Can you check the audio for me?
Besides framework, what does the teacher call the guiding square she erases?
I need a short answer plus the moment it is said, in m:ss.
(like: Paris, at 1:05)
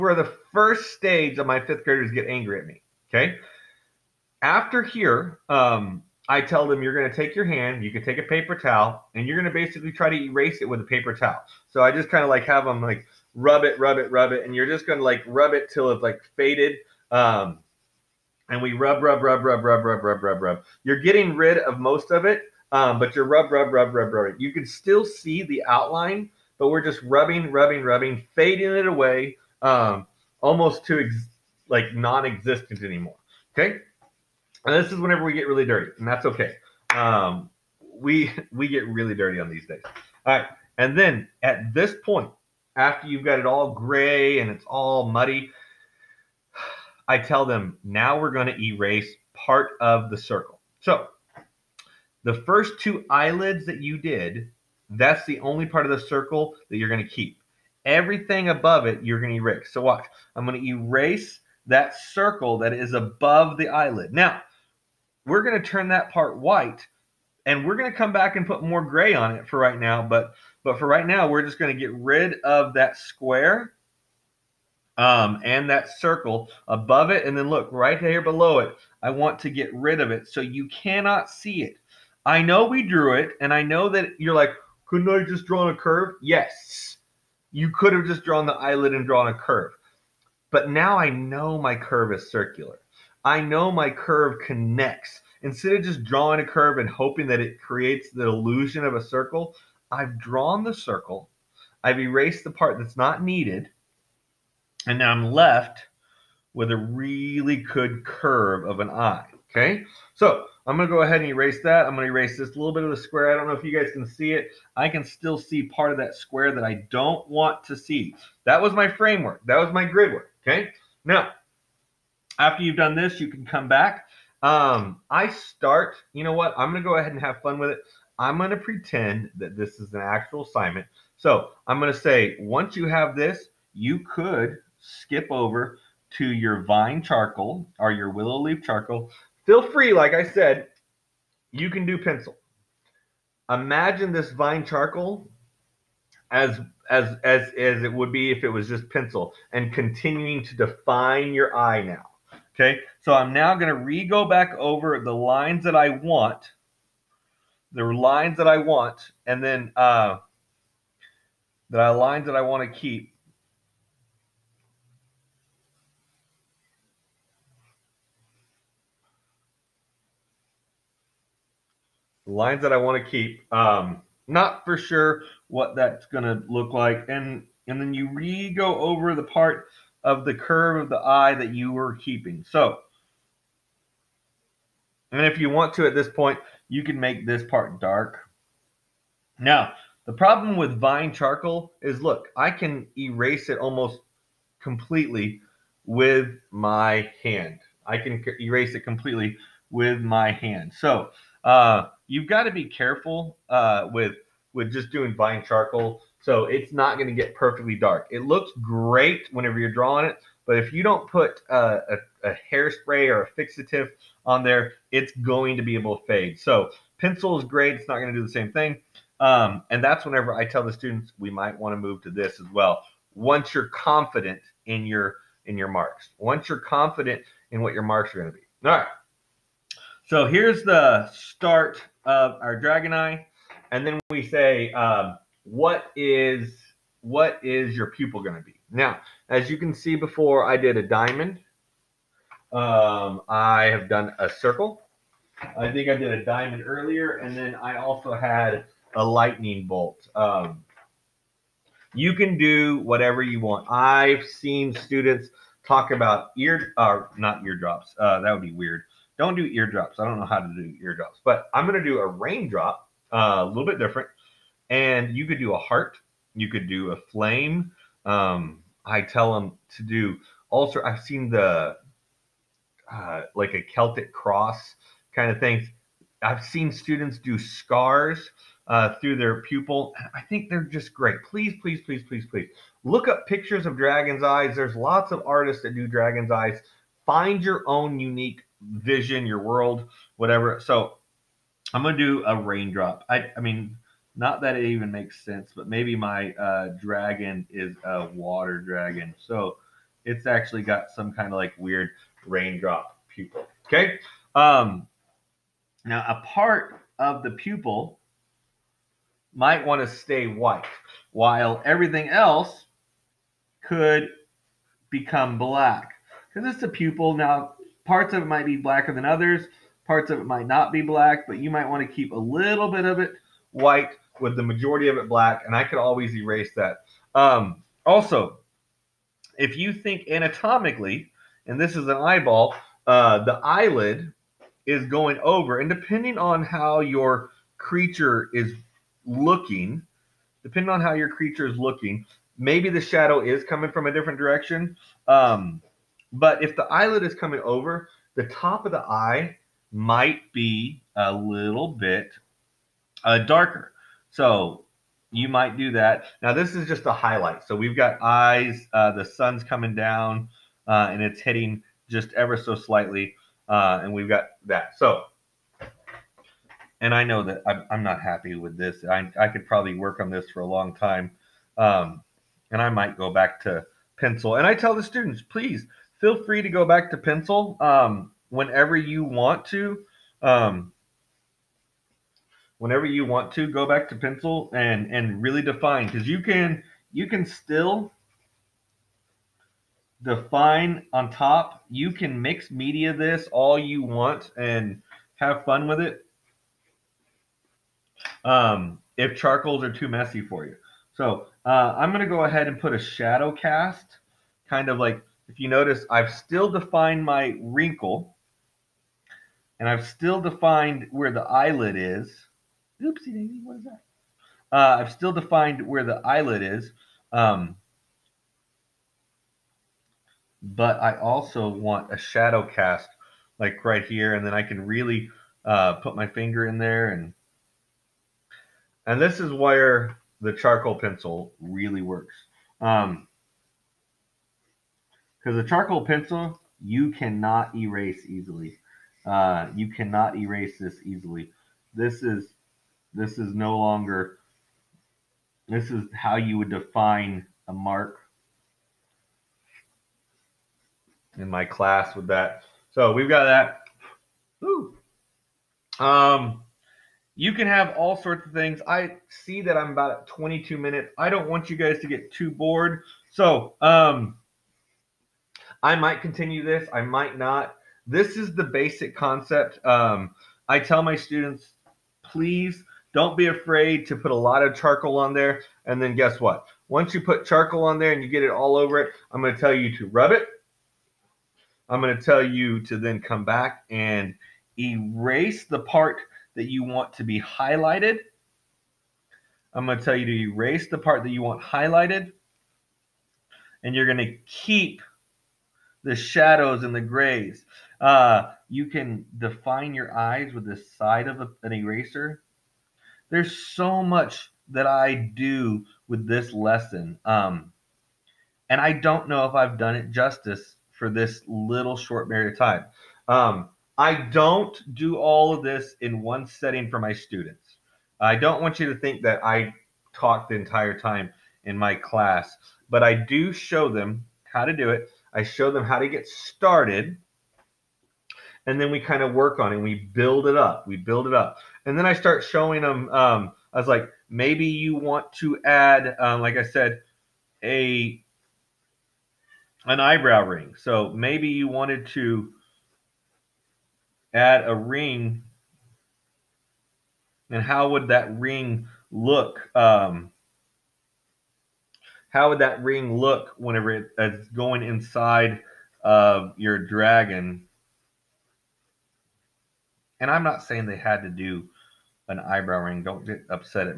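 grid work, at 1:59.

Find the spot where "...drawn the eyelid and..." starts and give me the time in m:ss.
1:28.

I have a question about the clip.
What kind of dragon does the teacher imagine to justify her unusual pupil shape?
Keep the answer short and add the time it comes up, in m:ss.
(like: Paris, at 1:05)
water dragon, at 4:58.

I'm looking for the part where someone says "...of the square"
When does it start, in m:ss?
1:52.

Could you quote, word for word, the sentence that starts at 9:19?
And I'm not saying they had to do an eyebrow ring.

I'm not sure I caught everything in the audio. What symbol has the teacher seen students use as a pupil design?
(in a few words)
Celtic cross.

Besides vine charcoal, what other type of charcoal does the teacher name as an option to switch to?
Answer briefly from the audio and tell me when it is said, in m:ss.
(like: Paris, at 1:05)
willow leaf charcoal, at 2:18.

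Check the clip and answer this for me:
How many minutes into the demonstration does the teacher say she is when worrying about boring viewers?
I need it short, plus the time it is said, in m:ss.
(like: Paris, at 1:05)
22, at 7:40.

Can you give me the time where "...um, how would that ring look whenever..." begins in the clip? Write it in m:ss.
9:09.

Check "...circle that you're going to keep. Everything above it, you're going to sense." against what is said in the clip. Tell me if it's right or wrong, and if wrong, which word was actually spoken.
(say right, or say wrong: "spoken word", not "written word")
wrong: "erase", not "sense".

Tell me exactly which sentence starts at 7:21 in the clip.
This is this is no longer this is how you would define a mark.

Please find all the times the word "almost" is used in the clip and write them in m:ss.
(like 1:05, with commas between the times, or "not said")
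0:30, 3:13.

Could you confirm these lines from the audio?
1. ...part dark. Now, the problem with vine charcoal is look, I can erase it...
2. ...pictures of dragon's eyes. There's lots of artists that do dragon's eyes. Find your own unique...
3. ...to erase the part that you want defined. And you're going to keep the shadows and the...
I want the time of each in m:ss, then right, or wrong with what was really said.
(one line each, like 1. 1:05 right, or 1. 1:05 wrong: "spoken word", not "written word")
1. 3:07 right
2. 4:43 right
3. 8:10 wrong: "highlighted", not "defined".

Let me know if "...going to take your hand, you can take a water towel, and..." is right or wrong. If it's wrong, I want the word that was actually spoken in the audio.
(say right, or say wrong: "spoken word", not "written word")
wrong: "paper", not "water".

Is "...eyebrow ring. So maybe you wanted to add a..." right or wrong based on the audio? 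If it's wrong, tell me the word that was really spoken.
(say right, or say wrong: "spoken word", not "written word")
right.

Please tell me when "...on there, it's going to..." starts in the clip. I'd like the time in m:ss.
3:34.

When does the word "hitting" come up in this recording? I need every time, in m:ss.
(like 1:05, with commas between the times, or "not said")
6:01.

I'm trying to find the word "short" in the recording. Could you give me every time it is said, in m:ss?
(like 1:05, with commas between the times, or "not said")
8:31.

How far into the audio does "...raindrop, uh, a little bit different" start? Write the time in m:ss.
4:22.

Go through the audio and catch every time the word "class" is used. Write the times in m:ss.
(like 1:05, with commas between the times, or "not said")
7:31, 8:41.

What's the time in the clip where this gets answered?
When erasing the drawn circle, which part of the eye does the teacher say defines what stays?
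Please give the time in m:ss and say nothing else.
0:52.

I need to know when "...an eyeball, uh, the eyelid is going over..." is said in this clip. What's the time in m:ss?
5:31.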